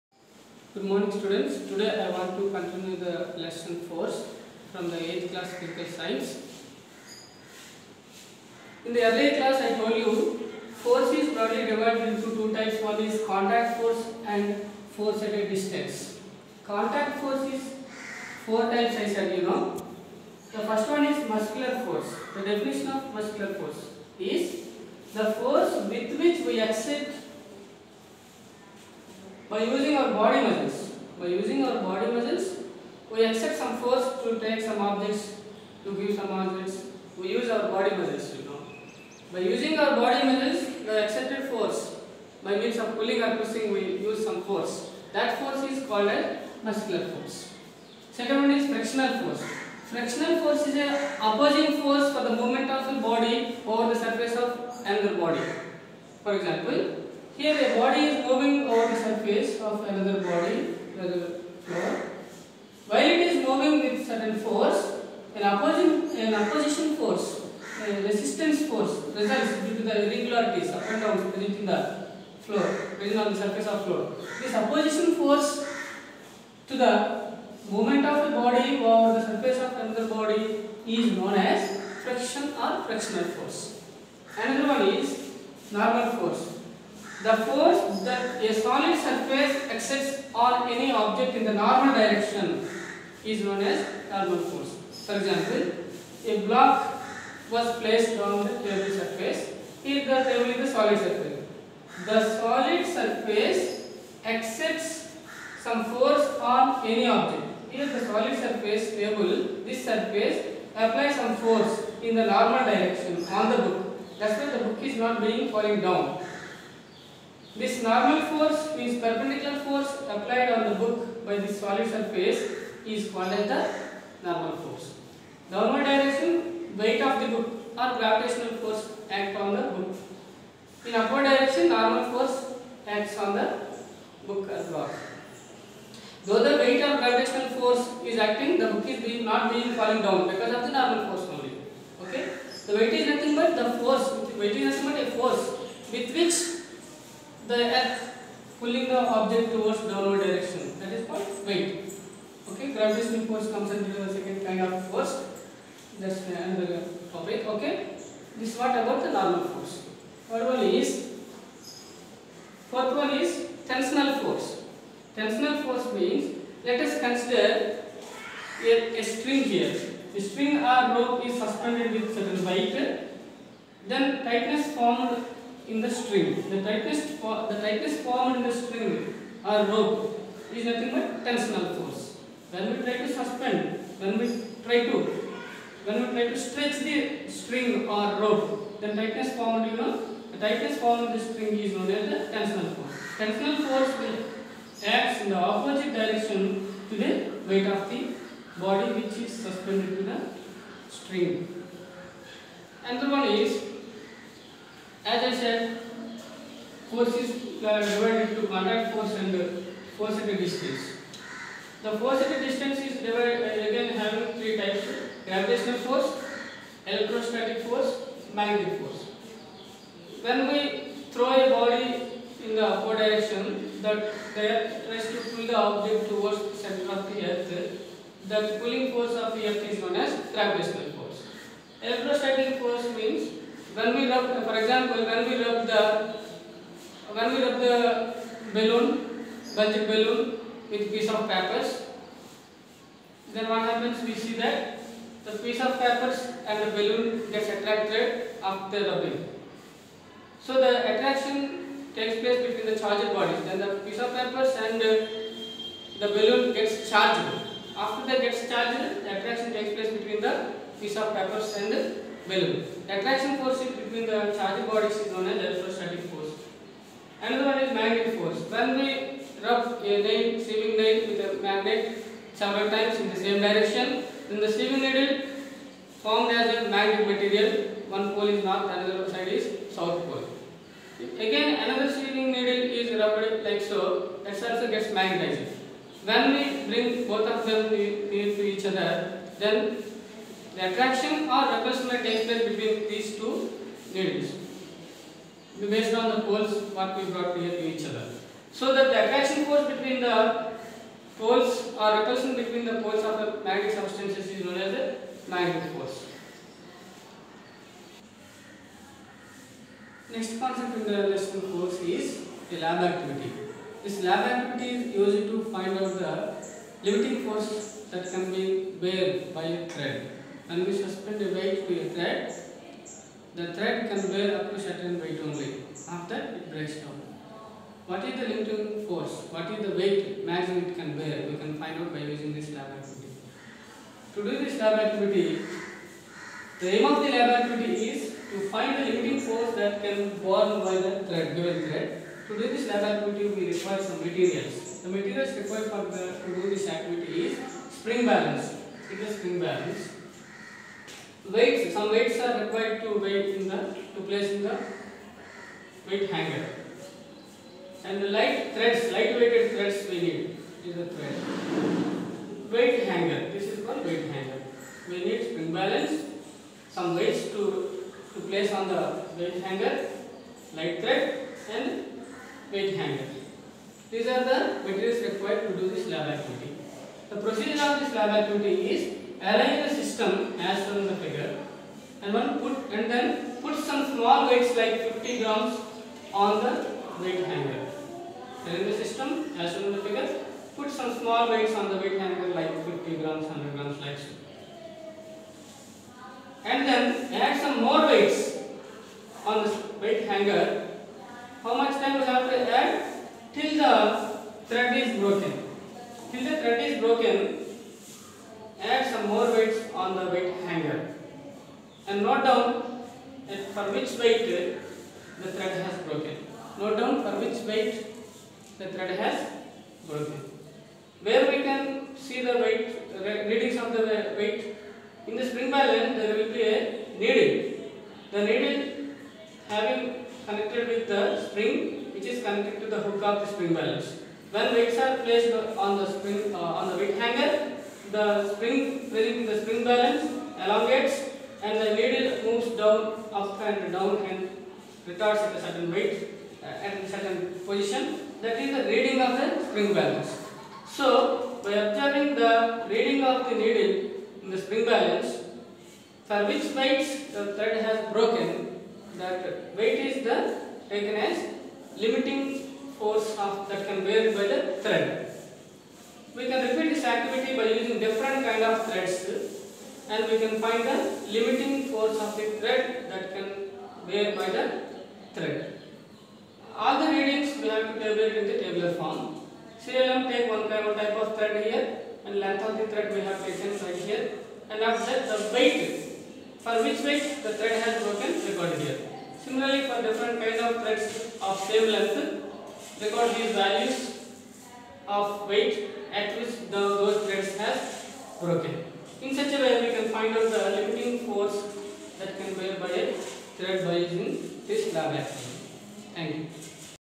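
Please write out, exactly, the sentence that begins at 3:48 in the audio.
The pulling force of the earth is known as gravitational force.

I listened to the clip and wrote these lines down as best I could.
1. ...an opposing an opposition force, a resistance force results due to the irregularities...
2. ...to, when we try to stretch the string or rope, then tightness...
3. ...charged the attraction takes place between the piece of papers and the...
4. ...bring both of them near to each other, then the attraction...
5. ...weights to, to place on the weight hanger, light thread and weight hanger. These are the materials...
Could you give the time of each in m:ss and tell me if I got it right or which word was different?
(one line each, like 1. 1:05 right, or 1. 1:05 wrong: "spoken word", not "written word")
1. 1:05 right
2. 3:04 right
3. 4:18 right
4. 4:46 right
5. 6:06 right.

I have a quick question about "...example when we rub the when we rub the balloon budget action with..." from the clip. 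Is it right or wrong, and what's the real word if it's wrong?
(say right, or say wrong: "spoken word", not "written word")
wrong: "balloon", not "action".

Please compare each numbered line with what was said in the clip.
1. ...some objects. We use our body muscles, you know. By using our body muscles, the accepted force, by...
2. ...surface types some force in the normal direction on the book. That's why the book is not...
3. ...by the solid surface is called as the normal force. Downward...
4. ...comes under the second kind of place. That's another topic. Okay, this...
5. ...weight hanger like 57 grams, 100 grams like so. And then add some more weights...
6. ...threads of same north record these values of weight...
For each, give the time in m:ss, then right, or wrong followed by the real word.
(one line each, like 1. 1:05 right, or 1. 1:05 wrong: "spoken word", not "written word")
1. 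0:36 right
2. 1:49 wrong: "applies", not "types"
3. 2:01 right
4. 2:33 wrong: "force", not "place"
5. 6:31 wrong: "50", not "57"
6. 8:10 wrong: "length", not "north".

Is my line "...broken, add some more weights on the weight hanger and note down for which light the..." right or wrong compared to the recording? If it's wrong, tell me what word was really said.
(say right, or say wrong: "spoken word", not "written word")
wrong: "weight", not "light".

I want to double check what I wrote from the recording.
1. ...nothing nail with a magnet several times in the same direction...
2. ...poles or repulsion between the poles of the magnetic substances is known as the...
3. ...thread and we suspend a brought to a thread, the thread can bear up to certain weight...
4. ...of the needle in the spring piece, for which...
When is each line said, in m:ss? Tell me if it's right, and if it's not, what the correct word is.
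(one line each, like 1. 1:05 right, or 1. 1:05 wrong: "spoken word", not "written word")
1. 4:30 wrong: "sewing", not "nothing"
2. 5:01 right
3. 5:19 wrong: "weight", not "brought"
4. 7:33 wrong: "balance", not "piece".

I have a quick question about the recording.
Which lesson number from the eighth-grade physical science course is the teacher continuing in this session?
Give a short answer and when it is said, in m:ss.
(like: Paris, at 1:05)
4, at 0:03.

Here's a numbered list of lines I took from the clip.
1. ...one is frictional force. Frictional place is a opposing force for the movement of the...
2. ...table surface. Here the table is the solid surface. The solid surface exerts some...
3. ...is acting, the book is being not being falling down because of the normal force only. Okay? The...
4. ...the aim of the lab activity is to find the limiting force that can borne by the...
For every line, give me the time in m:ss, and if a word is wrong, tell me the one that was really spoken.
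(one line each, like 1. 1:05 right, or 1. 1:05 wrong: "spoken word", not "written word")
1. 0:48 wrong: "force", not "place"
2. 1:38 right
3. 2:18 right
4. 5:36 right.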